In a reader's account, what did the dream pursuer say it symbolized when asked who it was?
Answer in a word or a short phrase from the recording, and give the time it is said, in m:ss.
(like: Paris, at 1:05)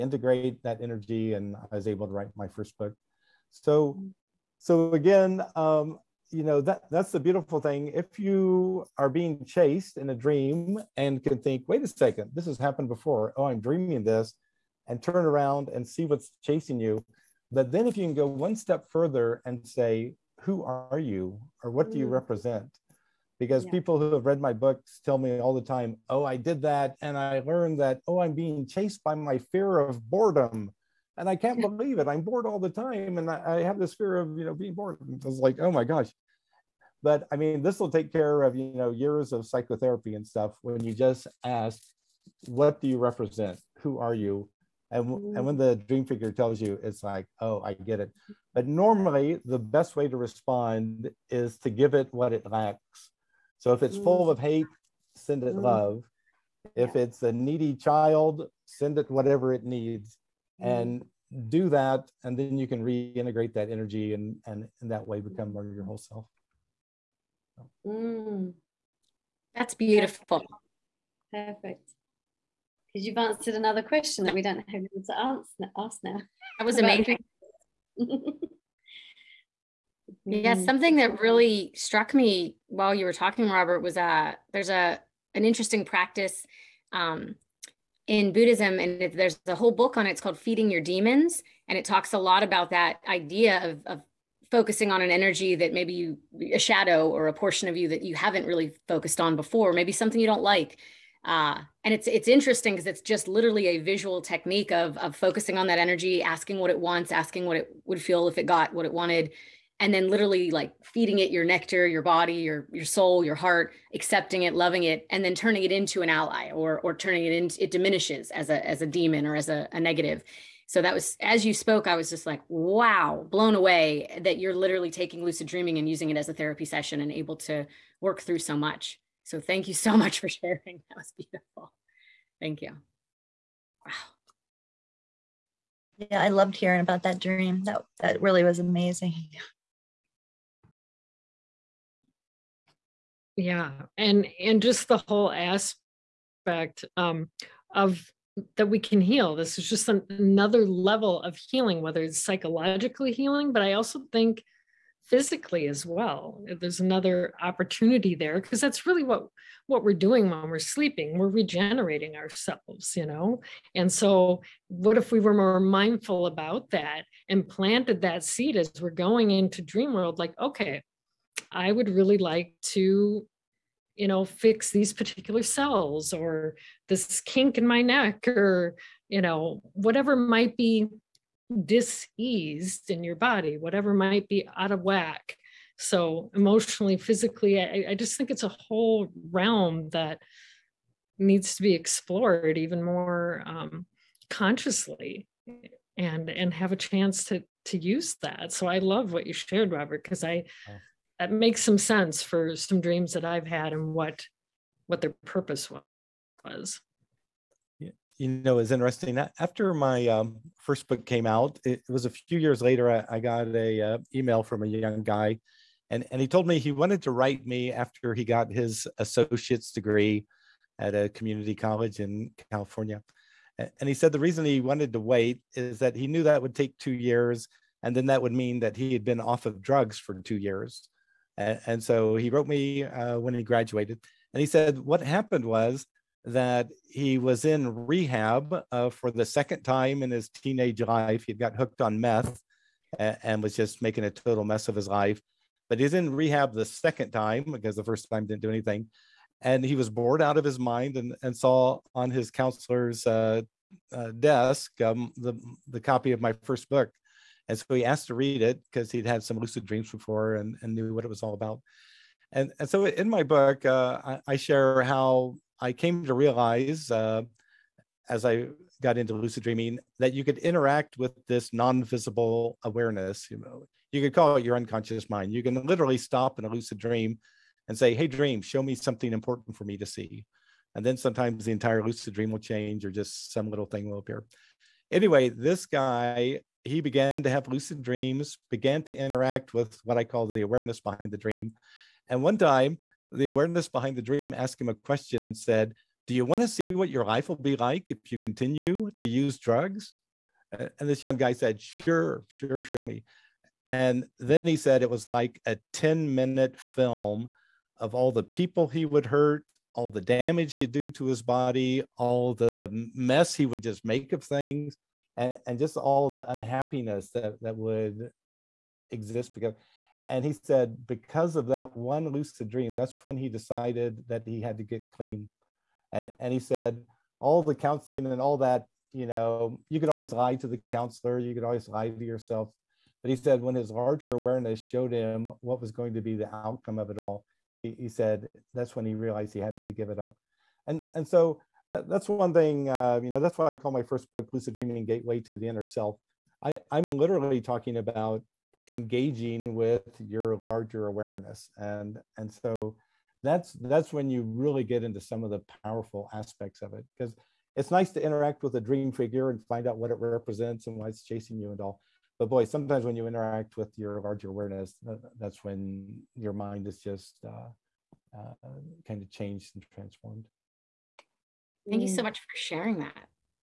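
fear of boredom, at 0:29.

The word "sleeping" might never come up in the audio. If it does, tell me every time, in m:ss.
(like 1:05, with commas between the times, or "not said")
2:40.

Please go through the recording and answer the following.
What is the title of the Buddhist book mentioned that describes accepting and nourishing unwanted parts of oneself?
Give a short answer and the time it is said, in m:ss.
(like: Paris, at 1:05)
Feeding Your Demons, at 1:30.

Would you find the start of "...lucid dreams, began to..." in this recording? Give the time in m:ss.
4:47.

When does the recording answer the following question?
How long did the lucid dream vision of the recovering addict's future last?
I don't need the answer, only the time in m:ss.
5:05.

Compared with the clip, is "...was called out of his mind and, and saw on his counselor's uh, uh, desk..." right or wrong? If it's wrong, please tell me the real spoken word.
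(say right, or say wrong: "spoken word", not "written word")
wrong: "bored", not "called".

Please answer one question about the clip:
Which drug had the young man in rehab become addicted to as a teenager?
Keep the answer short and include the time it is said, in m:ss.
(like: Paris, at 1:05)
meth, at 4:01.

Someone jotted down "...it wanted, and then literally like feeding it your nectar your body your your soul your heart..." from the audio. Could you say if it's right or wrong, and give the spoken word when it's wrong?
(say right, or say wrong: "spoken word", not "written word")
right.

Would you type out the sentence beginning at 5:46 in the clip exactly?
I, I'm literally talking about engaging with your larger awareness.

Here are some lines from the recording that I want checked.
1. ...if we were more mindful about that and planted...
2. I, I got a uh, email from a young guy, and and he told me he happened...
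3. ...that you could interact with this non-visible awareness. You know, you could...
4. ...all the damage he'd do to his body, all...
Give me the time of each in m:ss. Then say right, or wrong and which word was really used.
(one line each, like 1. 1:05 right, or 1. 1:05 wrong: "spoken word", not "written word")
1. 2:44 right
2. 3:32 wrong: "wanted", not "happened"
3. 4:29 right
4. 5:09 right.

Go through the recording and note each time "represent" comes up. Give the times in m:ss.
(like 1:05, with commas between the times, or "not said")
0:22, 0:42, 5:59.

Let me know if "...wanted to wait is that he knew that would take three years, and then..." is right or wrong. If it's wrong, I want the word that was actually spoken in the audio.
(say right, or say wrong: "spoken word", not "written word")
wrong: "two", not "three".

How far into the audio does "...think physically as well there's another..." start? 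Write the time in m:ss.
2:34.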